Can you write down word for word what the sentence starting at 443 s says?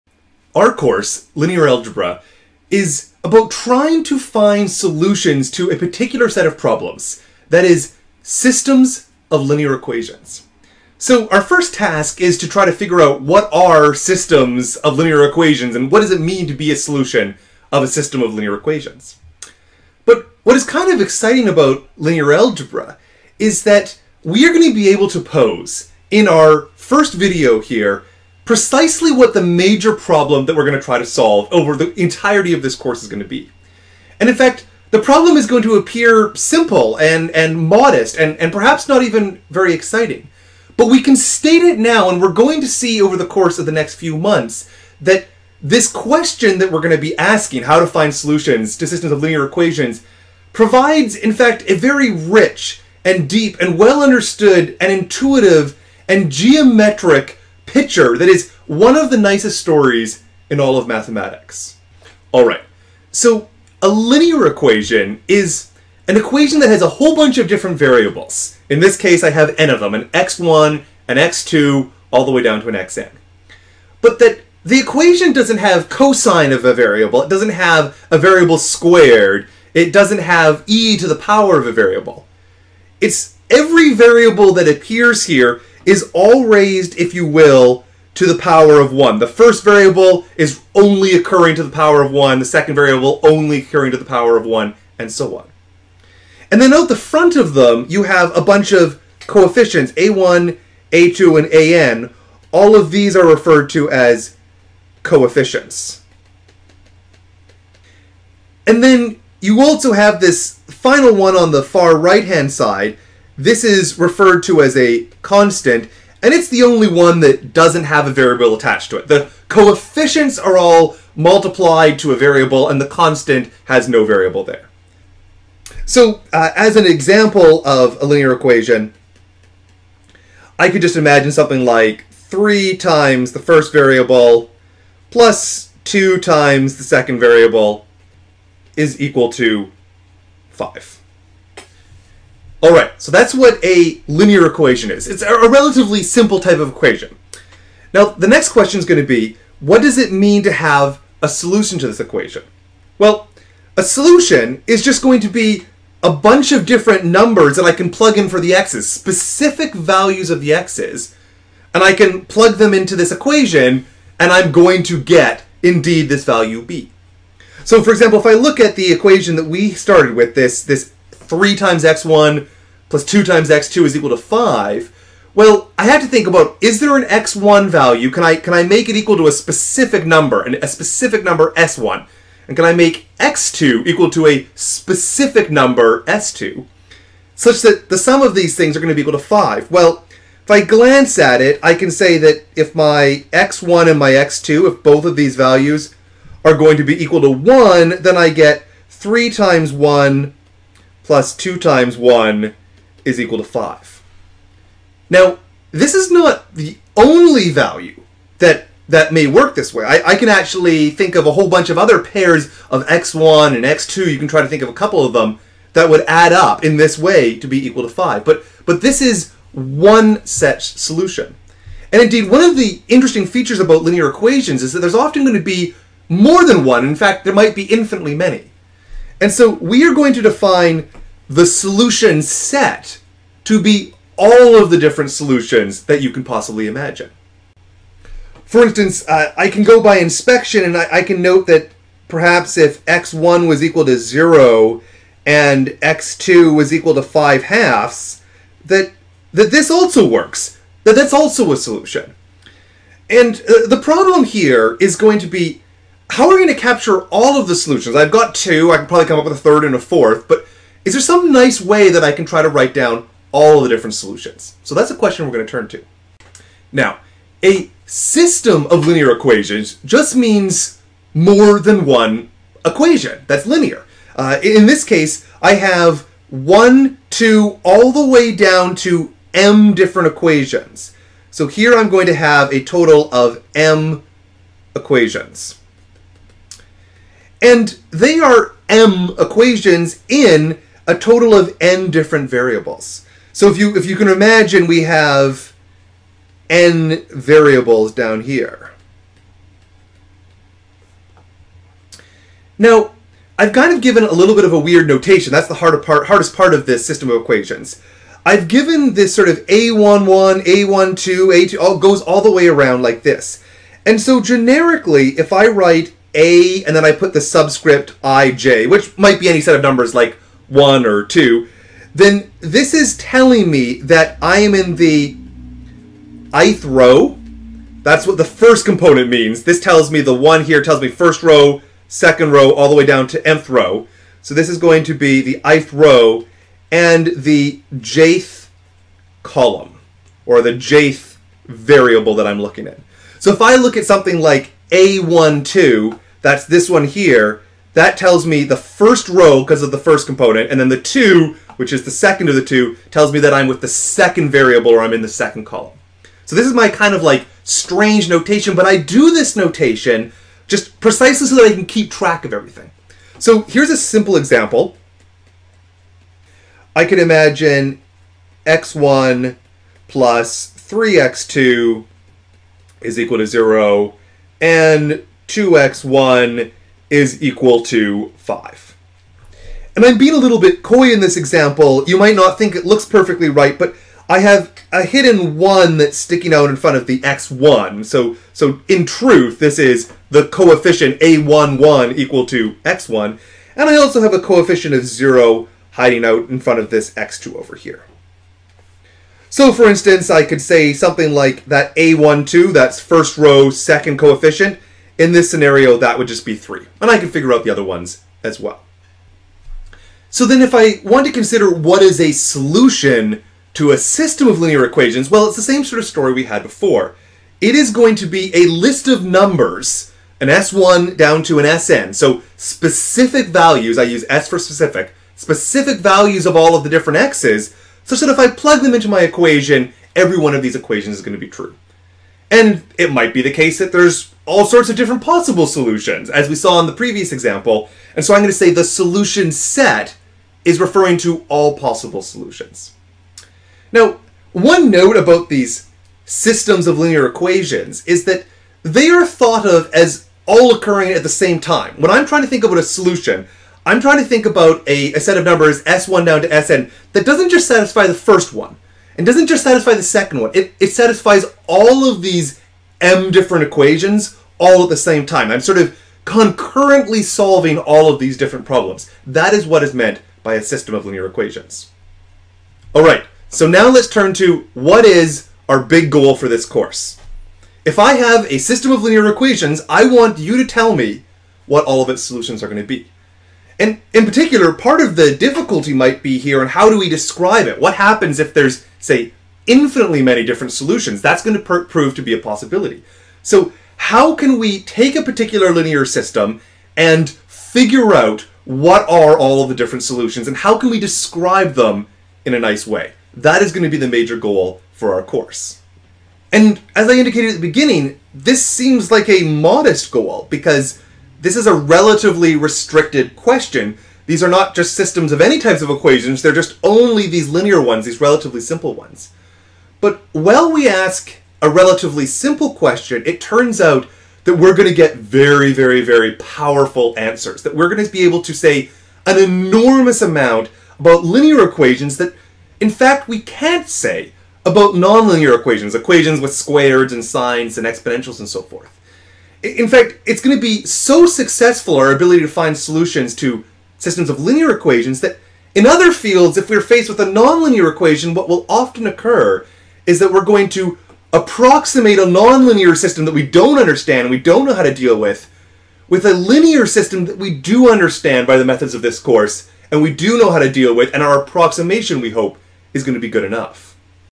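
Now, one note about these systems of linear equations is that they are thought of as all occurring at the same time.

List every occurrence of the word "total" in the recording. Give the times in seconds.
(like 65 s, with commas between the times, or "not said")
282 s, 290 s.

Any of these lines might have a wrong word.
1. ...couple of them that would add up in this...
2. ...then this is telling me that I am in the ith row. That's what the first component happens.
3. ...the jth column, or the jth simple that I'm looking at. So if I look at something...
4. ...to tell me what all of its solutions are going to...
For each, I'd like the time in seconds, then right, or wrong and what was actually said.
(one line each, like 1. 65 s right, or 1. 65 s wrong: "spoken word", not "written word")
1. 214 s right
2. 321 s wrong: "means", not "happens"
3. 337 s wrong: "variable", not "simple"
4. 480 s right.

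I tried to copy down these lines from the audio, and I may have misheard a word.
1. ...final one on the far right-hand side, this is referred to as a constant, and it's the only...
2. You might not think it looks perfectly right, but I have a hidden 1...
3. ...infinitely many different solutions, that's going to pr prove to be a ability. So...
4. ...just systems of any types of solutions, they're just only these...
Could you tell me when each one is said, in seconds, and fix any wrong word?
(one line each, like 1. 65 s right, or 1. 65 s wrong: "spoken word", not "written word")
1. 110 s right
2. 381 s right
3. 489 s wrong: "possibility", not "ability"
4. 514 s wrong: "equations", not "solutions".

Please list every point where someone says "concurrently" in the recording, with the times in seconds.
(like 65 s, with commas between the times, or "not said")
466 s.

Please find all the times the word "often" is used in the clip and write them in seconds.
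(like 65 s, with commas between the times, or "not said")
224 s, 548 s.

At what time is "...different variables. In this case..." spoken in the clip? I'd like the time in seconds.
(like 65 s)
67 s.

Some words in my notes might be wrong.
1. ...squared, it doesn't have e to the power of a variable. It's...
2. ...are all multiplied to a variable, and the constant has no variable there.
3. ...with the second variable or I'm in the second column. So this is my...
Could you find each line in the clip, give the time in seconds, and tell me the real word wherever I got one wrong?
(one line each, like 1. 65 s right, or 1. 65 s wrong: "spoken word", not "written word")
1. 78 s right
2. 120 s right
3. 353 s right.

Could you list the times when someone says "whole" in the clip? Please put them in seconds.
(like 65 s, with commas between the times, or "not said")
66 s, 211 s.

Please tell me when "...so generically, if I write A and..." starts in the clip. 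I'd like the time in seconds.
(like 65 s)
313 s.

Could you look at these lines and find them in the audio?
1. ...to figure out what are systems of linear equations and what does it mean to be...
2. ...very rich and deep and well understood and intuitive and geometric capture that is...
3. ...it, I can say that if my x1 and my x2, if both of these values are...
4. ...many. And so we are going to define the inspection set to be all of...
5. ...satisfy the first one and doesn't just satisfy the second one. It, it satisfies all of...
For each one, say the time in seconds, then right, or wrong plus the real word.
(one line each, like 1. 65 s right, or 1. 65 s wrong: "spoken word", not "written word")
1. 12 s right
2. 51 s wrong: "picture", not "capture"
3. 191 s right
4. 228 s wrong: "solution", not "inspection"
5. 457 s right.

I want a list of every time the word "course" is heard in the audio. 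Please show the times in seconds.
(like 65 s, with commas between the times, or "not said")
0 s, 32 s, 43 s, 476 s, 505 s, 558 s.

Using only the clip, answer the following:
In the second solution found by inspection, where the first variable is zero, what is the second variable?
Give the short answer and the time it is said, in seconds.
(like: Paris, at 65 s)
5 halves, at 247 s.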